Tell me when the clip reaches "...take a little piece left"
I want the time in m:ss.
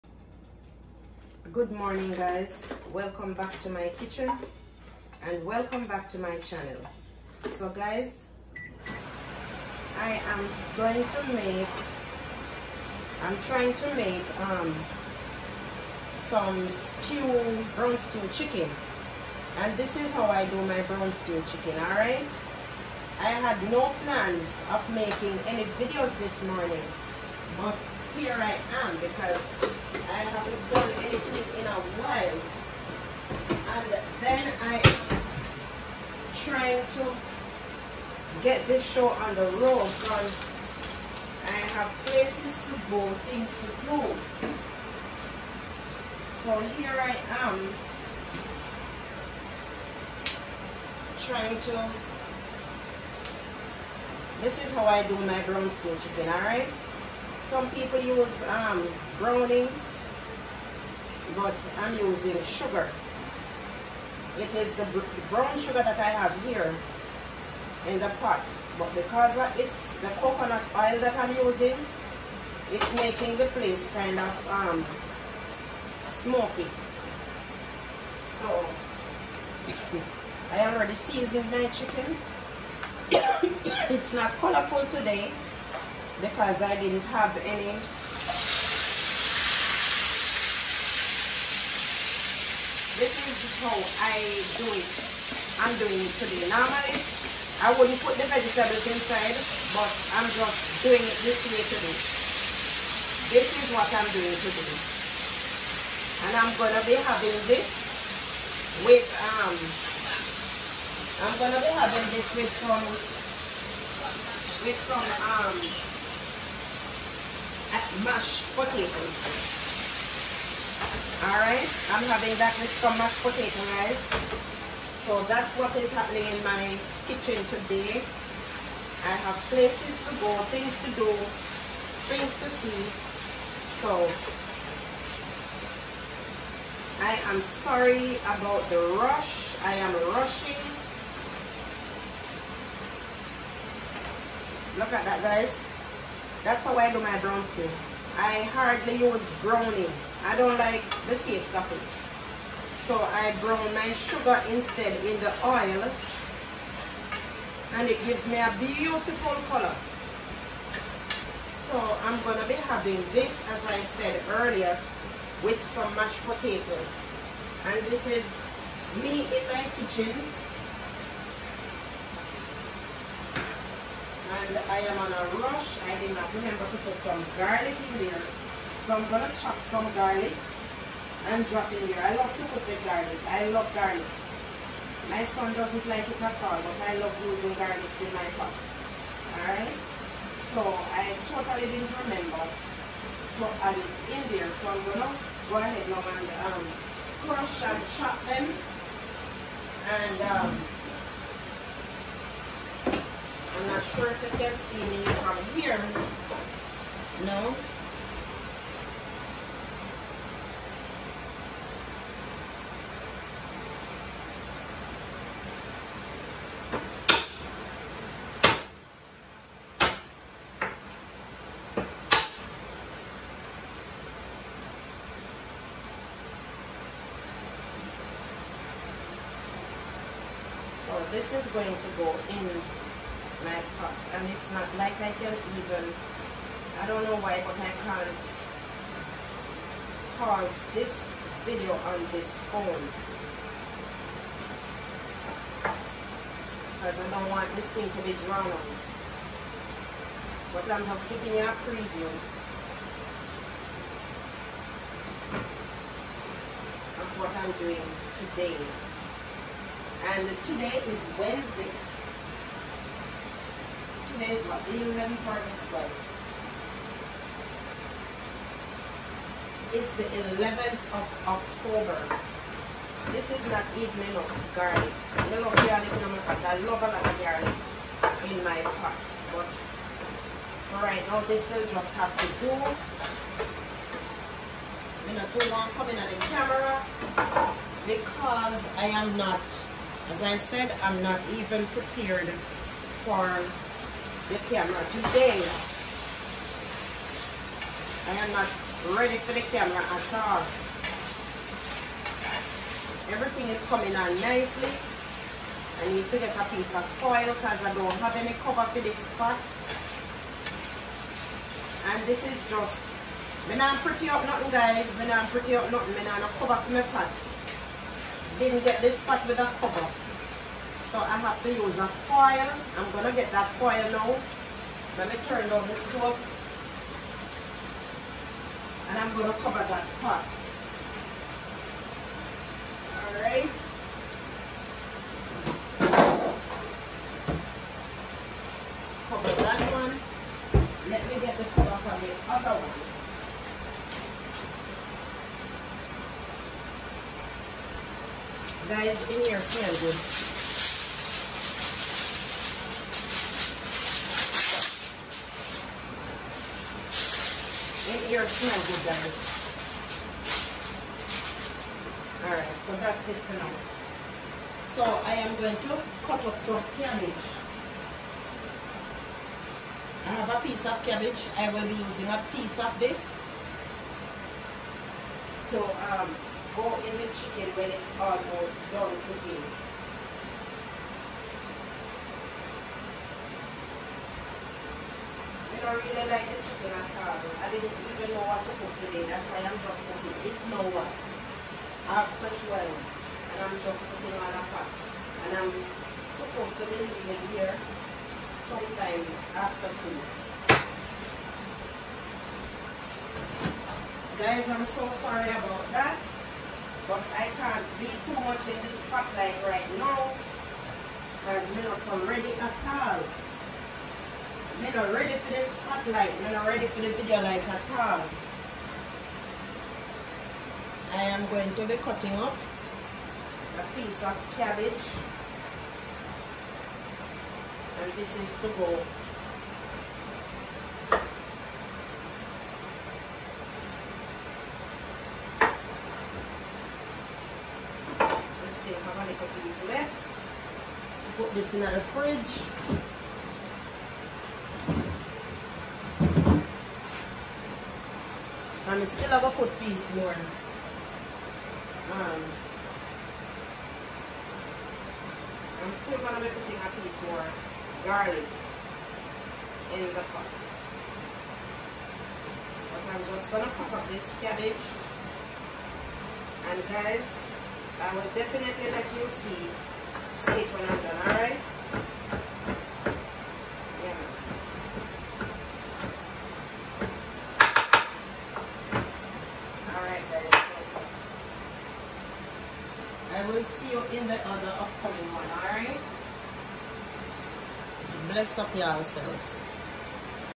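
7:18.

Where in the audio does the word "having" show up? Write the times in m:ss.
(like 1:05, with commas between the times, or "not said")
1:46, 1:51, 2:02, 2:42.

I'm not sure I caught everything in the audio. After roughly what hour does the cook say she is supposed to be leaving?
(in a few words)
2.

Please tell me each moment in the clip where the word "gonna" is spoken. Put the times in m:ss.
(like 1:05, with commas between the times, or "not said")
2:42, 7:35, 7:43.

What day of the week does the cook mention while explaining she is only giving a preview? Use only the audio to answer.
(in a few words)
Wednesday.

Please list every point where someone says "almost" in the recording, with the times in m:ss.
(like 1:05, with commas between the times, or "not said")
6:17.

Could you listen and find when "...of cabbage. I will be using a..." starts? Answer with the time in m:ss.
6:10.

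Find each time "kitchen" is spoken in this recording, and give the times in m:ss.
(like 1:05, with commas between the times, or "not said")
0:03, 2:07, 2:49.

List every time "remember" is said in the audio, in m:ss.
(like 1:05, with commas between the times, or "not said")
2:56, 3:12.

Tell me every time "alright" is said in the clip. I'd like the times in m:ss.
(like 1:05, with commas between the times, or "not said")
0:21, 0:56, 2:01, 3:09, 5:33, 6:02, 7:51.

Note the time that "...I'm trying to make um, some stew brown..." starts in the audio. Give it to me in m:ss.
0:13.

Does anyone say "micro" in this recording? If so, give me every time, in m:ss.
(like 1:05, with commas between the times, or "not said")
not said.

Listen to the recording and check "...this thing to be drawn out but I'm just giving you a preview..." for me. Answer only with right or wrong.
right.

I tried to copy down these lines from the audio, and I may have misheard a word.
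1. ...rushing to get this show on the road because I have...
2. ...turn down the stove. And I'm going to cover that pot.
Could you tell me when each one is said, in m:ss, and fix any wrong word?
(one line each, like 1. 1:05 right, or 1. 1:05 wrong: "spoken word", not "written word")
1. 0:36 wrong: "trying", not "rushing"
2. 5:25 right.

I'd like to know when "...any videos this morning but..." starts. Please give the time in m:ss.
0:25.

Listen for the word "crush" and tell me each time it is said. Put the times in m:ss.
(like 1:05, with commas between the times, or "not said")
3:17.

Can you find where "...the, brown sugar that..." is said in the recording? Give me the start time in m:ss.
1:04.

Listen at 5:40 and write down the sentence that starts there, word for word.
Let me get the cover for the other one.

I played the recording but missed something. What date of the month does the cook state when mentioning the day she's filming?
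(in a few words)
11th of October.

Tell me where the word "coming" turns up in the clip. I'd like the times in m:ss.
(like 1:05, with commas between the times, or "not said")
4:45, 5:03.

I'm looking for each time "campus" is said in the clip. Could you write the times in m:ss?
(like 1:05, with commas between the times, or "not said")
not said.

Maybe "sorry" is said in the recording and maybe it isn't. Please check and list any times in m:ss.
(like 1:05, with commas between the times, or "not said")
2:17, 6:45.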